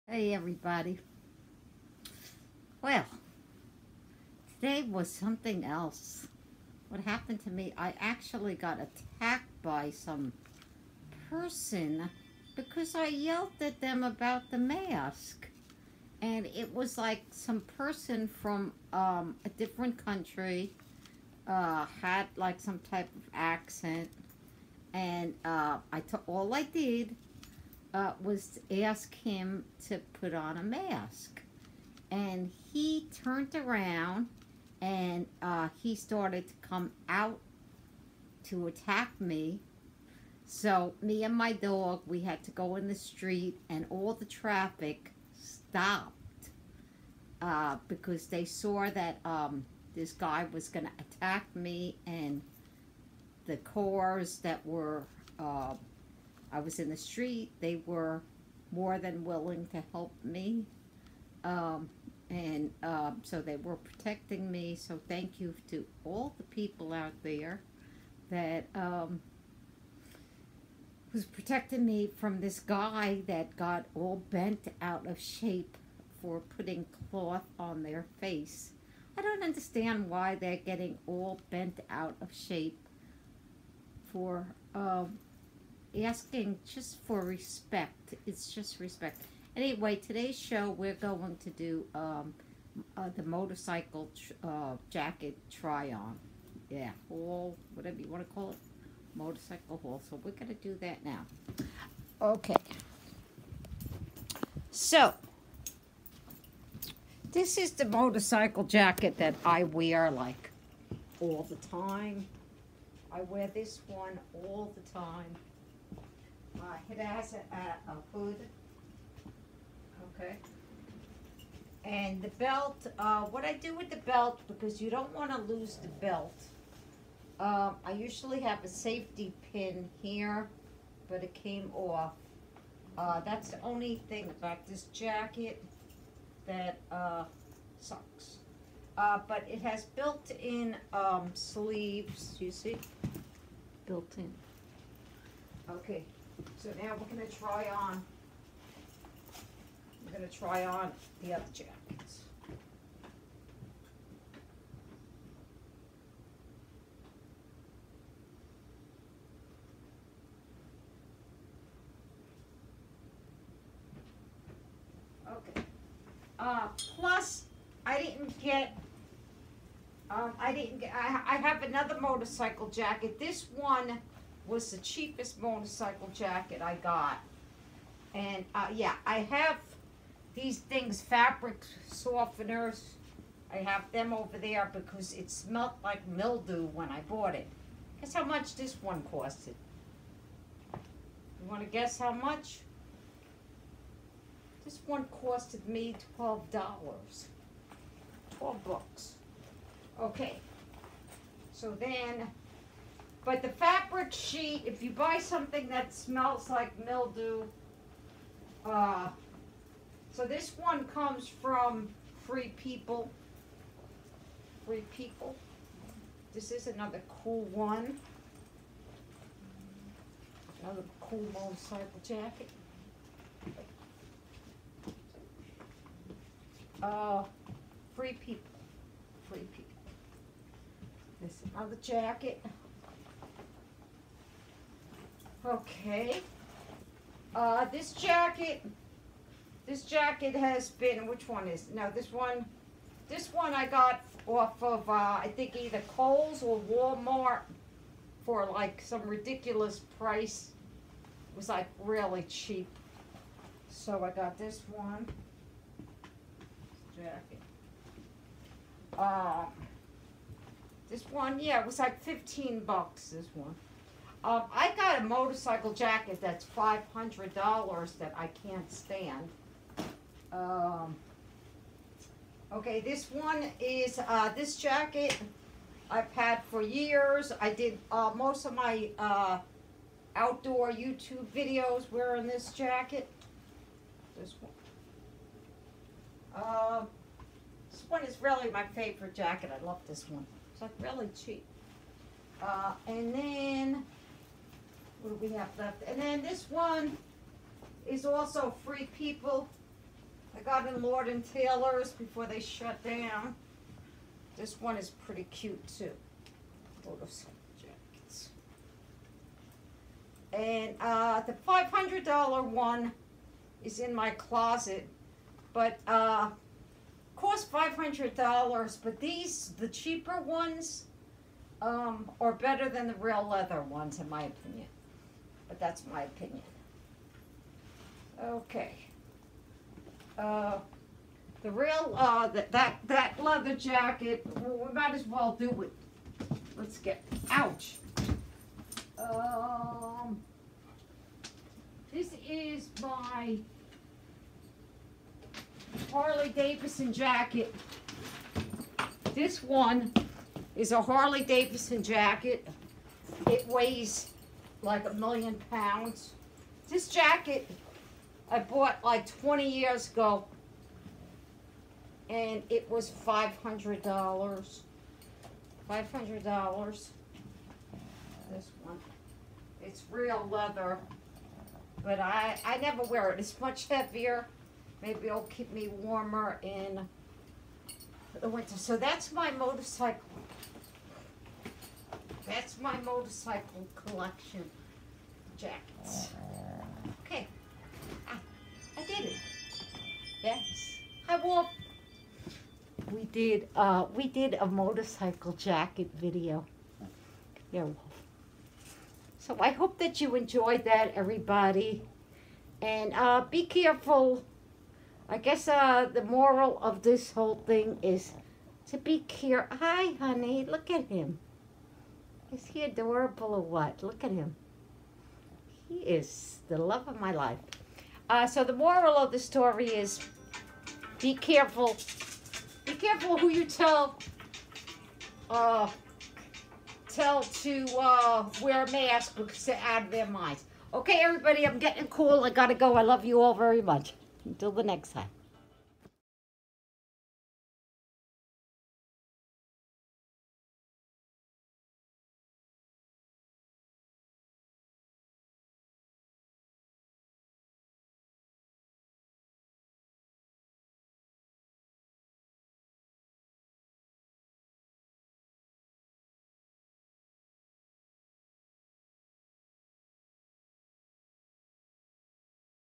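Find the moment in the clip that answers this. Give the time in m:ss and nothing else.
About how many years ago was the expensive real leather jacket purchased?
5:59.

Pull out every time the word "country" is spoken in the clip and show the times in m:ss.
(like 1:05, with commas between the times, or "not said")
0:20.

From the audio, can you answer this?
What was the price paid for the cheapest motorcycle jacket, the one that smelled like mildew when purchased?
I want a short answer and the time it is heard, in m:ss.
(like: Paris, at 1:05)
$12, at 3:15.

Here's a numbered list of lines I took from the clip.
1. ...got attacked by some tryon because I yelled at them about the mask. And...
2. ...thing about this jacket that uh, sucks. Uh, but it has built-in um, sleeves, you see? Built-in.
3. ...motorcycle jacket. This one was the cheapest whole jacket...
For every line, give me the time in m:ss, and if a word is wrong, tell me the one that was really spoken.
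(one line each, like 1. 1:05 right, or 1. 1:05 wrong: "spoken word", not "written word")
1. 0:08 wrong: "person", not "tryon"
2. 2:14 right
3. 2:52 wrong: "motorcycle", not "whole".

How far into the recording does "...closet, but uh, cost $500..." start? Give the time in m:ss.
5:14.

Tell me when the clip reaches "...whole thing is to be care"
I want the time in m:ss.
6:47.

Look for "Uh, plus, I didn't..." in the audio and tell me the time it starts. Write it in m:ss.
2:46.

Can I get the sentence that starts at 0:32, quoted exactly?
And he turned around and uh, he started to come out to attack me.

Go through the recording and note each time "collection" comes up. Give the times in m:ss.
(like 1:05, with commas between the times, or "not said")
6:23.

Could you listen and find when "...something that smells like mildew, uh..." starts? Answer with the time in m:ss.
3:25.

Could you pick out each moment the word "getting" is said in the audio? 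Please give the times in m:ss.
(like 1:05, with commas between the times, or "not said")
1:20, 7:11.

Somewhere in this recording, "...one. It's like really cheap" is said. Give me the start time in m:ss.
4:50.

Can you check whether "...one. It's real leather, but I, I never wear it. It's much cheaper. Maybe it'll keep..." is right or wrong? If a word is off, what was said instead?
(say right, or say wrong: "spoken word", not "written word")
wrong: "heavier", not "cheaper".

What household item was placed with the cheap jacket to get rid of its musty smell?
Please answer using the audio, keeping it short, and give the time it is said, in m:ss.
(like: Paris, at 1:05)
fabric softeners, at 3:01.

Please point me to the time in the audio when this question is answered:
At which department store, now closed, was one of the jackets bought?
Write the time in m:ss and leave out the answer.
5:00.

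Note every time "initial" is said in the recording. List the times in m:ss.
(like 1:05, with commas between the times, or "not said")
not said.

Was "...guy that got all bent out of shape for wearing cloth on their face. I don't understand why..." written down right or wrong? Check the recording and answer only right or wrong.
wrong.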